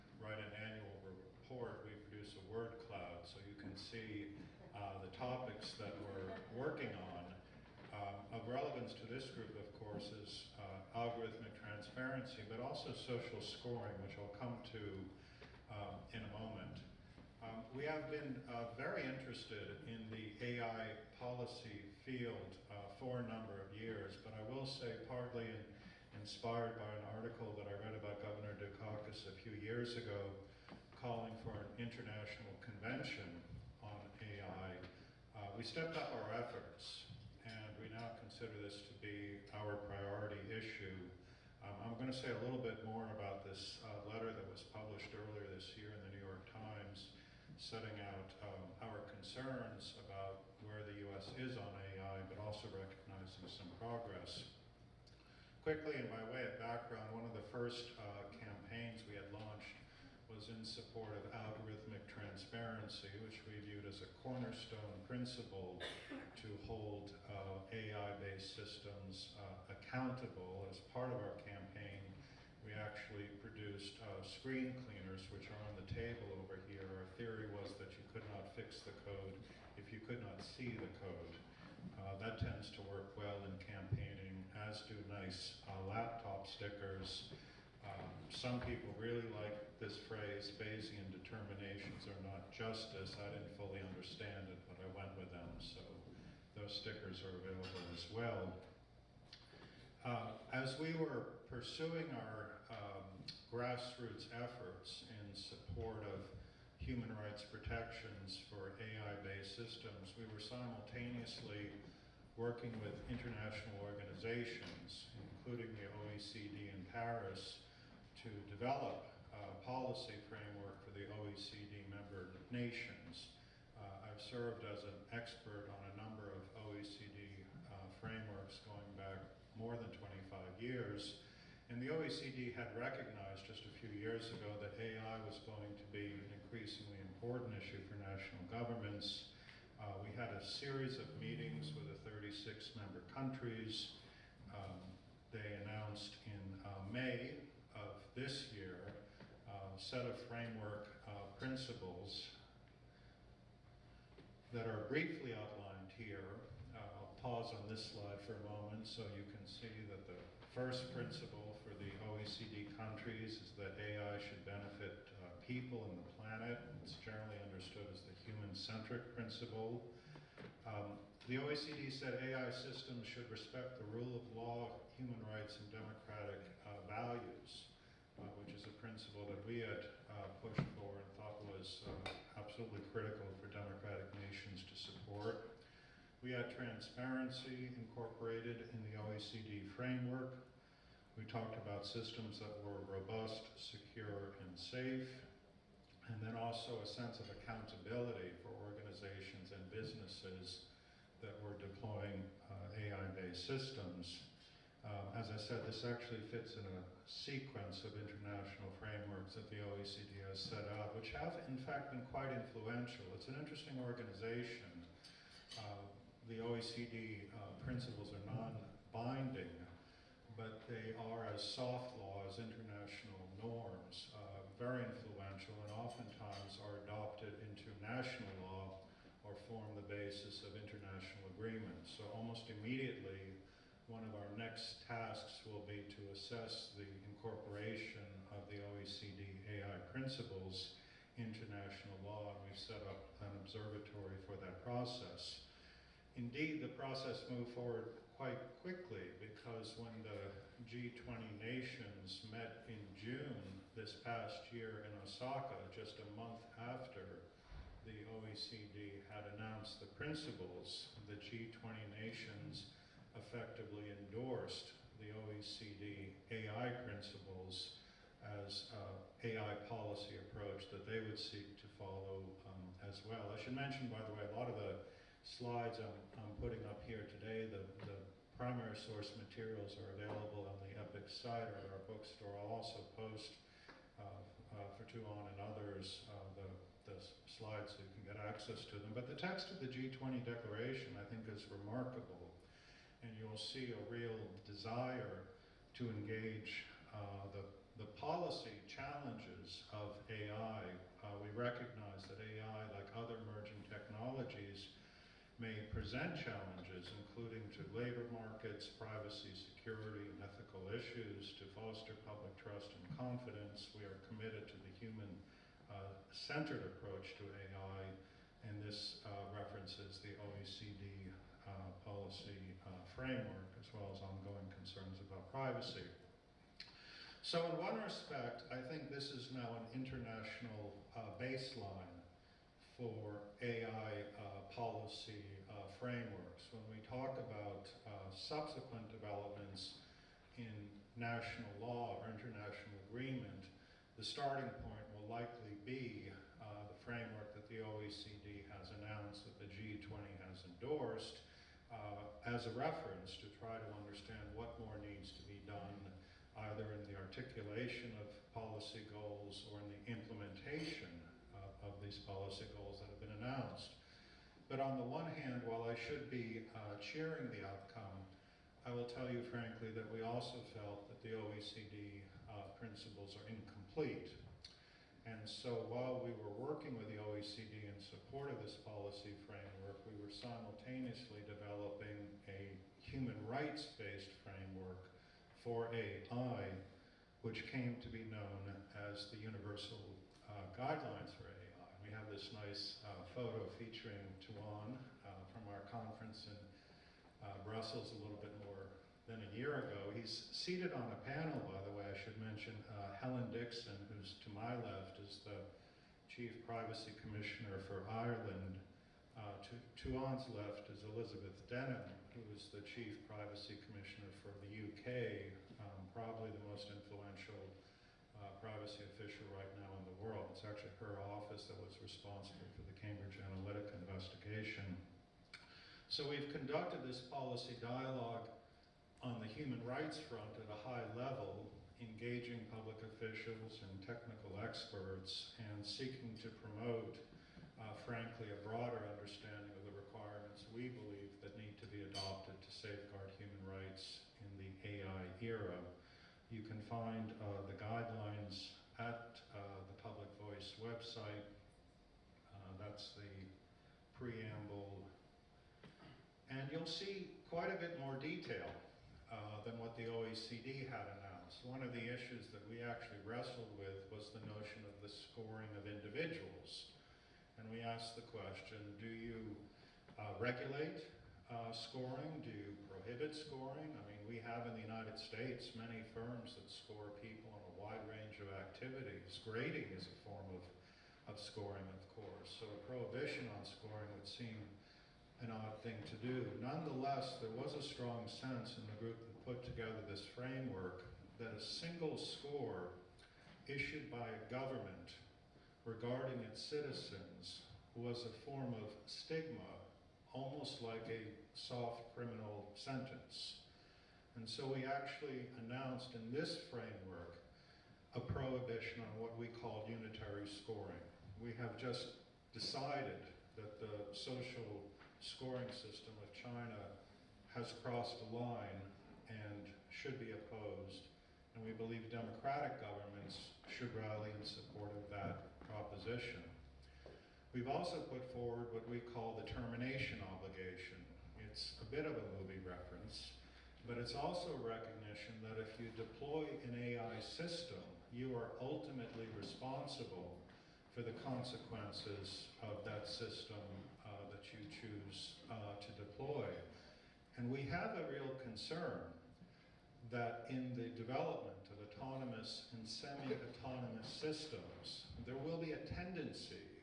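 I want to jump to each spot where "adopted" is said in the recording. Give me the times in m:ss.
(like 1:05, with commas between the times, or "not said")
3:46, 7:21.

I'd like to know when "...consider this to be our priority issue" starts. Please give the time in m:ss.
0:38.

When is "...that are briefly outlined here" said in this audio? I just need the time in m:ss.
2:34.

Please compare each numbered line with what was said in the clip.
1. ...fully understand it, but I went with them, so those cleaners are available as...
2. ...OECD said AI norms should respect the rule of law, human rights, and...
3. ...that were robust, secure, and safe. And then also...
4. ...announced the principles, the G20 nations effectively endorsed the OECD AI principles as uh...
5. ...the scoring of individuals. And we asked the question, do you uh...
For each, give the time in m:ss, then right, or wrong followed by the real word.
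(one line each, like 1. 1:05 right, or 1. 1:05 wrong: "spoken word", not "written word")
1. 1:33 wrong: "stickers", not "cleaners"
2. 2:51 wrong: "systems", not "norms"
3. 3:12 right
4. 4:19 right
5. 7:44 right.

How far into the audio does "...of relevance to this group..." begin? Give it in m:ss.
0:08.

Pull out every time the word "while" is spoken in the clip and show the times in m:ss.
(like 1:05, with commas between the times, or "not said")
6:05, 6:15.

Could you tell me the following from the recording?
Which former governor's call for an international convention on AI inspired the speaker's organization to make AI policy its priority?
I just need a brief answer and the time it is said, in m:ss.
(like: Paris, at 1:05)
Dukakis, at 0:28.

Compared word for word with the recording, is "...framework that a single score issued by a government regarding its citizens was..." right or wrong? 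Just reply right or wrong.
right.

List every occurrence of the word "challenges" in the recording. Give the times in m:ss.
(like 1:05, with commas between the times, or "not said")
4:58, 5:06.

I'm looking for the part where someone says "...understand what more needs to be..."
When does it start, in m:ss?
5:53.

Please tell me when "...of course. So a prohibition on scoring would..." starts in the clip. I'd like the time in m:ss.
8:01.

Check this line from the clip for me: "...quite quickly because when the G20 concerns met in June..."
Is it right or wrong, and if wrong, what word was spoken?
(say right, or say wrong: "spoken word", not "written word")
wrong: "nations", not "concerns".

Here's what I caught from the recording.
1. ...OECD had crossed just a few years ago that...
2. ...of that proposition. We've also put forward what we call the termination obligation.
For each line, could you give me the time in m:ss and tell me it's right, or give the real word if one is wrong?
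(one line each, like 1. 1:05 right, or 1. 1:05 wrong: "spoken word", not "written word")
1. 2:11 wrong: "recognized", not "crossed"
2. 8:44 right.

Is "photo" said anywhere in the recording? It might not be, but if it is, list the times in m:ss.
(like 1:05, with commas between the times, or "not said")
6:33.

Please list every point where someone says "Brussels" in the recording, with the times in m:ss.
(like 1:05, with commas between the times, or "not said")
6:37.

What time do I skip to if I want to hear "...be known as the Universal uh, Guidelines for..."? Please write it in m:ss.
6:27.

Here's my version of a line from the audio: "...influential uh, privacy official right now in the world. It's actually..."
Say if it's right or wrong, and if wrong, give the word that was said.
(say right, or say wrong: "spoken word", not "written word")
right.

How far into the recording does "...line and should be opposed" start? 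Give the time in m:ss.
8:38.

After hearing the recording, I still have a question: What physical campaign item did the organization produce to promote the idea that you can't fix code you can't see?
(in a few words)
Screen cleaners.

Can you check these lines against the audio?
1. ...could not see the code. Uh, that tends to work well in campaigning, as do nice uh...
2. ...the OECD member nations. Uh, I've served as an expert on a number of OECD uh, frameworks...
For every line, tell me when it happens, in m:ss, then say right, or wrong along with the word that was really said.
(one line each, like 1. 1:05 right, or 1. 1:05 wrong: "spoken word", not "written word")
1. 1:20 right
2. 2:00 right.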